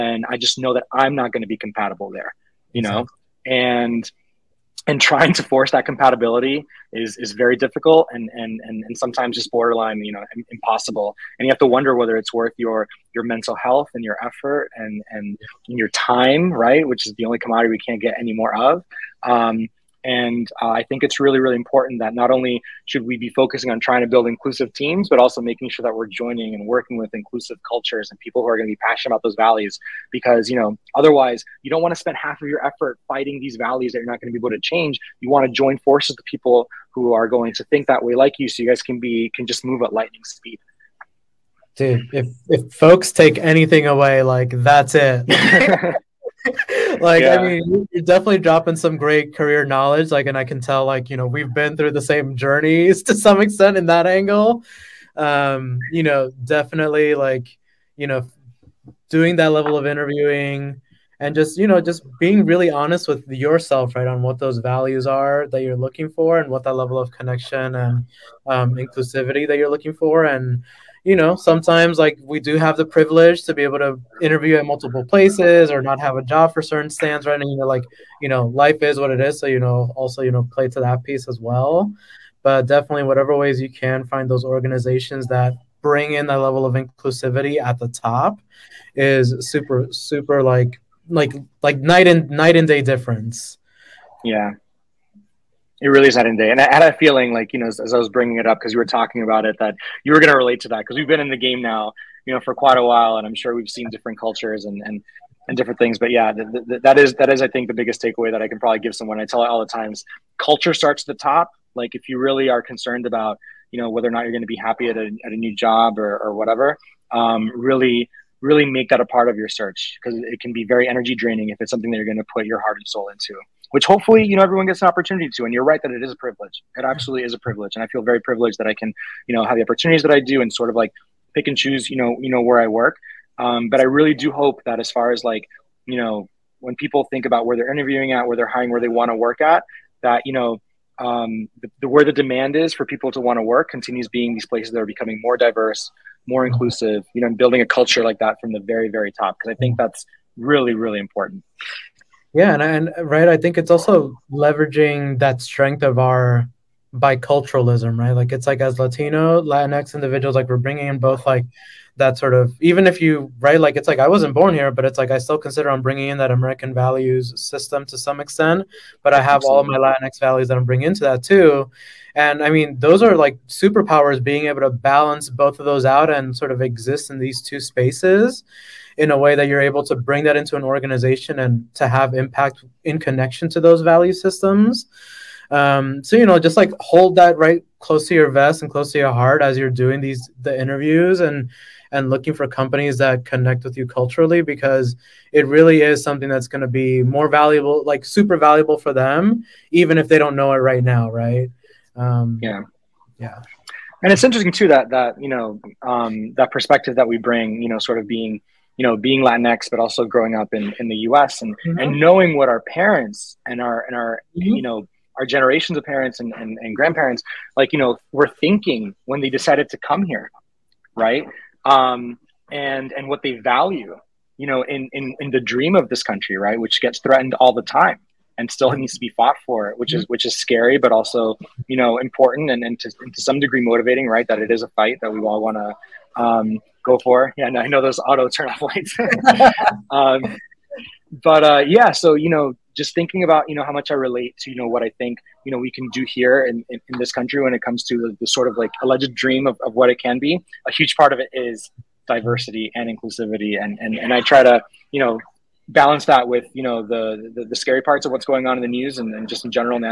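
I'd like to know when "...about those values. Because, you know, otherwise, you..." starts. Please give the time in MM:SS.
00:29.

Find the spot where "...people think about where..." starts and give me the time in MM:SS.
02:16.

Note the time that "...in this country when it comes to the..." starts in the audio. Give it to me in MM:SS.
04:06.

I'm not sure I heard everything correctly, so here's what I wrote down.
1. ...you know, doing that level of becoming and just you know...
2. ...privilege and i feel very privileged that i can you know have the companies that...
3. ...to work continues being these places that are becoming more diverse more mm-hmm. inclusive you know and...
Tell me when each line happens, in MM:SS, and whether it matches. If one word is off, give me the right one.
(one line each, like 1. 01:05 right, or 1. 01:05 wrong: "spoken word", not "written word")
1. 00:57 wrong: "interviewing", not "becoming"
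2. 02:07 wrong: "opportunities", not "companies"
3. 02:23 right.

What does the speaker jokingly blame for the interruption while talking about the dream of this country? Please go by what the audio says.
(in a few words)
auto turn off lights.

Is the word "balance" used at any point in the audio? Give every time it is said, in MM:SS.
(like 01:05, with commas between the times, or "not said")
02:54, 04:15.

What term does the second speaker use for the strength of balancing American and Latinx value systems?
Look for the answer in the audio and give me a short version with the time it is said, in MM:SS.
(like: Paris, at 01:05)
biculturalism, at 02:36.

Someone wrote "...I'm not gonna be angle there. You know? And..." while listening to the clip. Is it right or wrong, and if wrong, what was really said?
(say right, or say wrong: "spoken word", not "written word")
wrong: "compatible", not "angle".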